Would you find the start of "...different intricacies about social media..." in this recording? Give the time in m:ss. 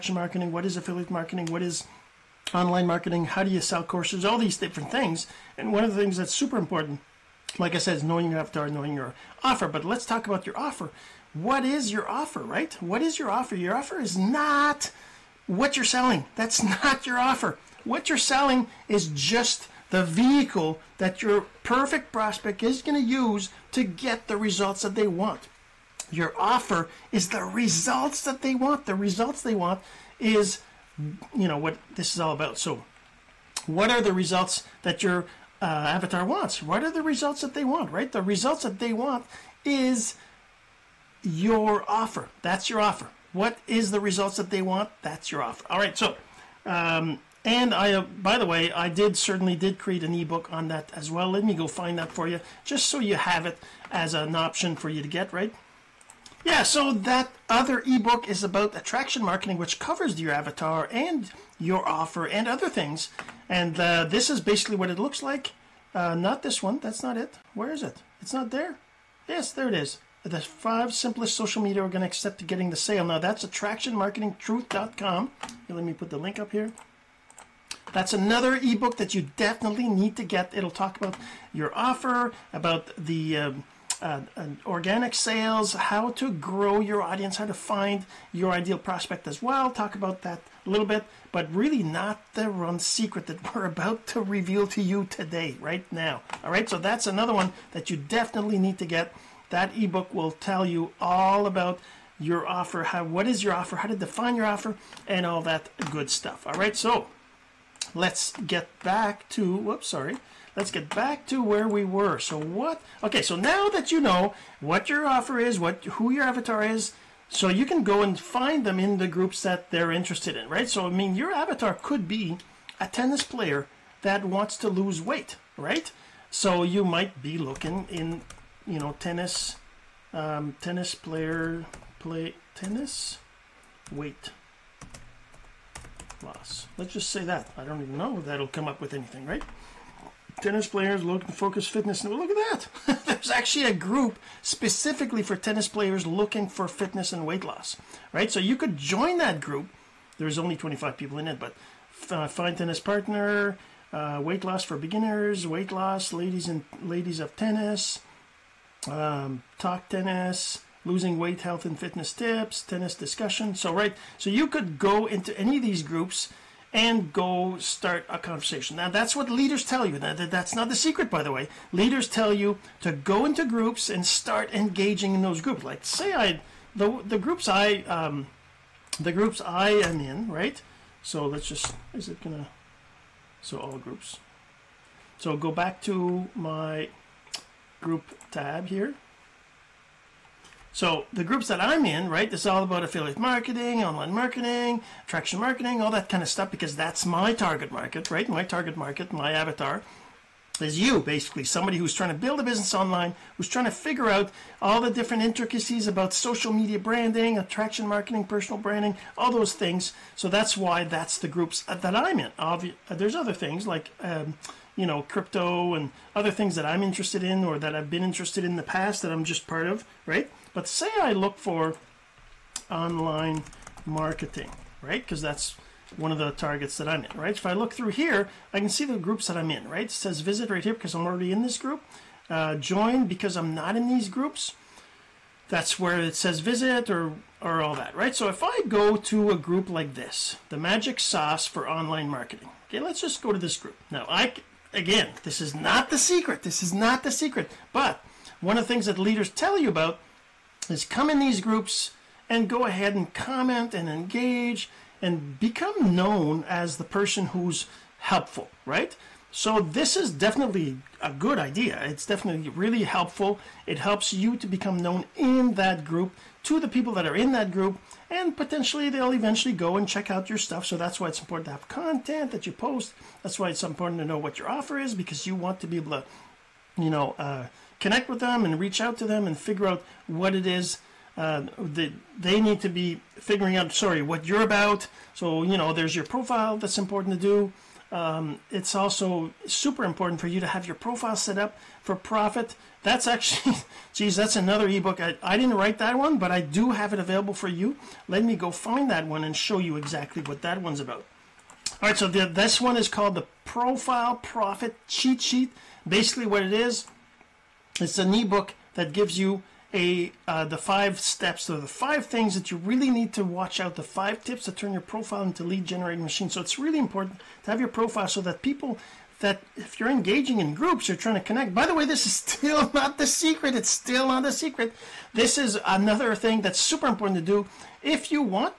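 3:24.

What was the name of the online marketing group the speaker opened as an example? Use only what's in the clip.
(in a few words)
The Magic Sauce.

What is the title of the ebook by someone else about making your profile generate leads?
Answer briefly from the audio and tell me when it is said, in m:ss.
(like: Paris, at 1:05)
Profile Profit Cheat Sheet, at 5:03.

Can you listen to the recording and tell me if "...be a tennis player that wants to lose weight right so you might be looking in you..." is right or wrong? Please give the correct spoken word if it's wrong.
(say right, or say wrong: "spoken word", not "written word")
right.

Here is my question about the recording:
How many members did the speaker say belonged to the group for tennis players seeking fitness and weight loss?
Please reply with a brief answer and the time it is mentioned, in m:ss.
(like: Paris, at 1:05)
25, at 2:30.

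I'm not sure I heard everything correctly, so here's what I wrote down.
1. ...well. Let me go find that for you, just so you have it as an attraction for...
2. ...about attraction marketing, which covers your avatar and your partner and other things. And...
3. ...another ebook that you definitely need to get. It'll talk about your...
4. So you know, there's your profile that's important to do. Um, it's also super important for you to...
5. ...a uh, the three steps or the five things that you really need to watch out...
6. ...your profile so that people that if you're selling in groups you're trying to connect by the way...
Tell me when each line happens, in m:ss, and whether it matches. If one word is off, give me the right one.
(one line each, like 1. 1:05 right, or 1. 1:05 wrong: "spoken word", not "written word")
1. 0:51 wrong: "option", not "attraction"
2. 0:58 wrong: "offer", not "partner"
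3. 1:18 right
4. 4:45 right
5. 5:09 wrong: "five", not "three"
6. 5:17 wrong: "engaging", not "selling".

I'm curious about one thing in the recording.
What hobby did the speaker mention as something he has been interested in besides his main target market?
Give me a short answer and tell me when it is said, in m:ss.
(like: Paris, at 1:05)
Crypto, at 3:35.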